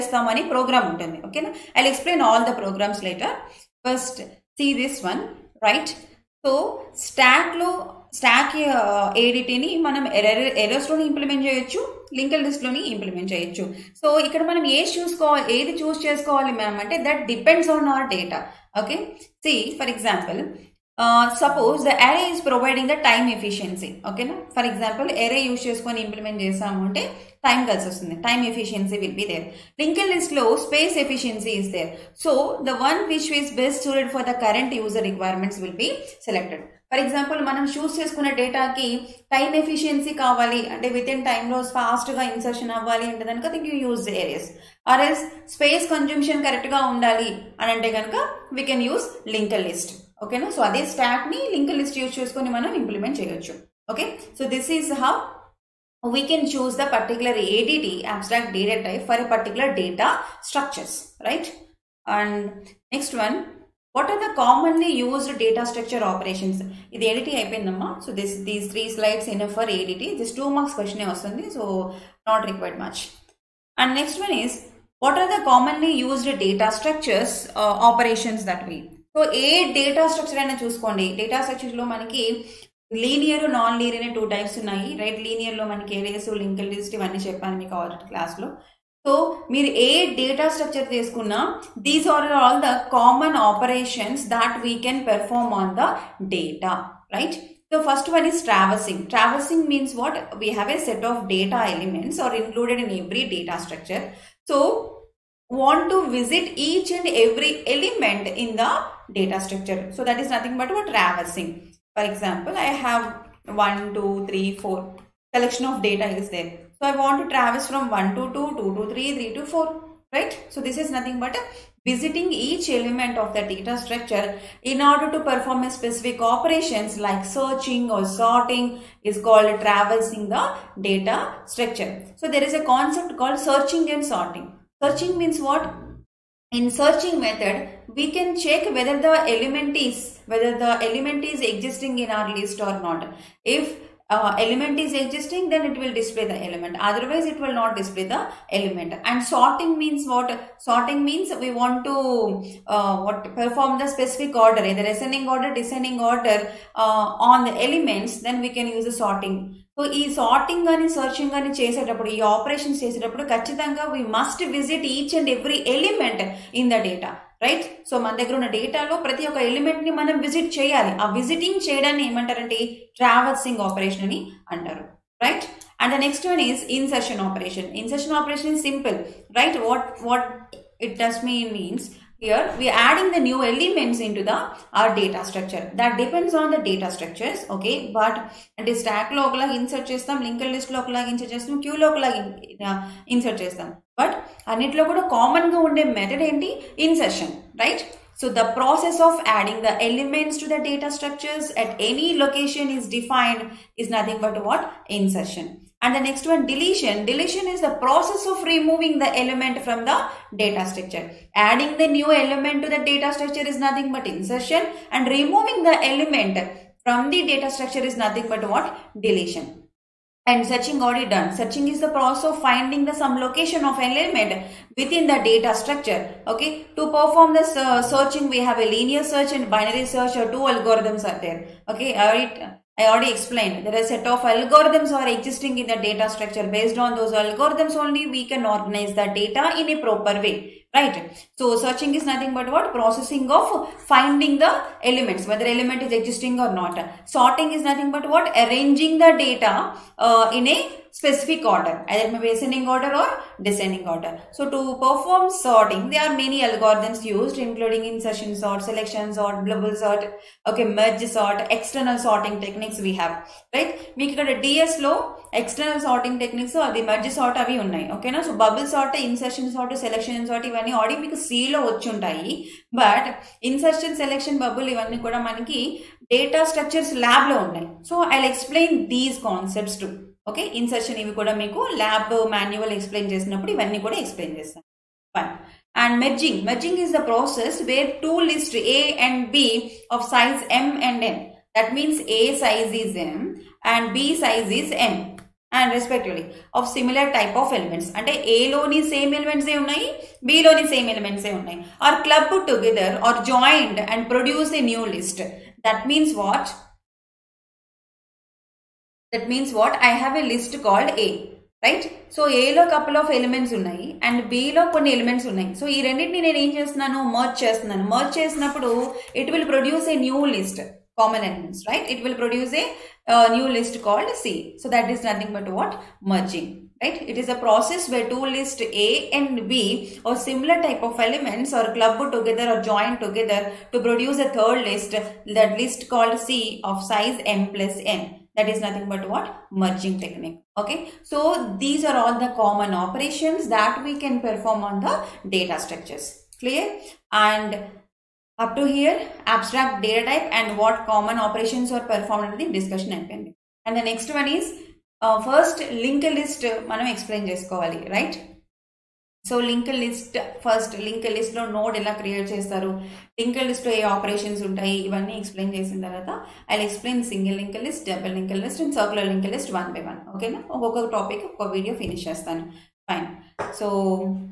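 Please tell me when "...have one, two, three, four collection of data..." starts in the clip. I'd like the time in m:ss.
1:52.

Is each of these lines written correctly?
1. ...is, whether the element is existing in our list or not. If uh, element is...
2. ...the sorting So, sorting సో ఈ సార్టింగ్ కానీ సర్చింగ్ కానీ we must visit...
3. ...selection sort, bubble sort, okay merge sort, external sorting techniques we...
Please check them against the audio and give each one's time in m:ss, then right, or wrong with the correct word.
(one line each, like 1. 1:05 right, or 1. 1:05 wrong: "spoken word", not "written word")
1. 2:19 right
2. 2:38 right
3. 4:18 right.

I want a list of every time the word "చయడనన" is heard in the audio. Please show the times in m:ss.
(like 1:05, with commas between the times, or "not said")
2:51.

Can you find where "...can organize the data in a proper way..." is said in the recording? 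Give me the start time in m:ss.
3:58.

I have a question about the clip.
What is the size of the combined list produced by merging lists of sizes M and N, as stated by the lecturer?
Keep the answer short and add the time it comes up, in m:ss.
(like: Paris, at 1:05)
M plus N, at 5:37.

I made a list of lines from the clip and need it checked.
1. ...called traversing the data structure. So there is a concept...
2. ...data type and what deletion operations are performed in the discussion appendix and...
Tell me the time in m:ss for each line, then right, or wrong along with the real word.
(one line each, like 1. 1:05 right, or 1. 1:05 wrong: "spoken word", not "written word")
1. 2:09 right
2. 5:49 wrong: "common", not "deletion".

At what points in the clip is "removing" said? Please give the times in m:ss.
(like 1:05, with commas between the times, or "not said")
3:28, 3:35.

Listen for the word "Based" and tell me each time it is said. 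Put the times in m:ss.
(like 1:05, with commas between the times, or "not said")
3:56.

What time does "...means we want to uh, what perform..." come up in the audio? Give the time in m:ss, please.
2:31.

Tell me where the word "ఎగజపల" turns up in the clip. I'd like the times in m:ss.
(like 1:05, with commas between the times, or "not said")
0:19, 0:24, 0:37.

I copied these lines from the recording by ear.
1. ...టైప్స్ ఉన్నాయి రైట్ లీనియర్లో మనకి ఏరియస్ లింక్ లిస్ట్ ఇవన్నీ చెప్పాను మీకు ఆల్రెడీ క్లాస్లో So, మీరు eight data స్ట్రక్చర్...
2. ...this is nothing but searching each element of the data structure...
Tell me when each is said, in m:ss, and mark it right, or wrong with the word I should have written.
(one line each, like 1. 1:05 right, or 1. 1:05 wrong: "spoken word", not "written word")
1. 1:24 right
2. 2:00 wrong: "visiting", not "searching".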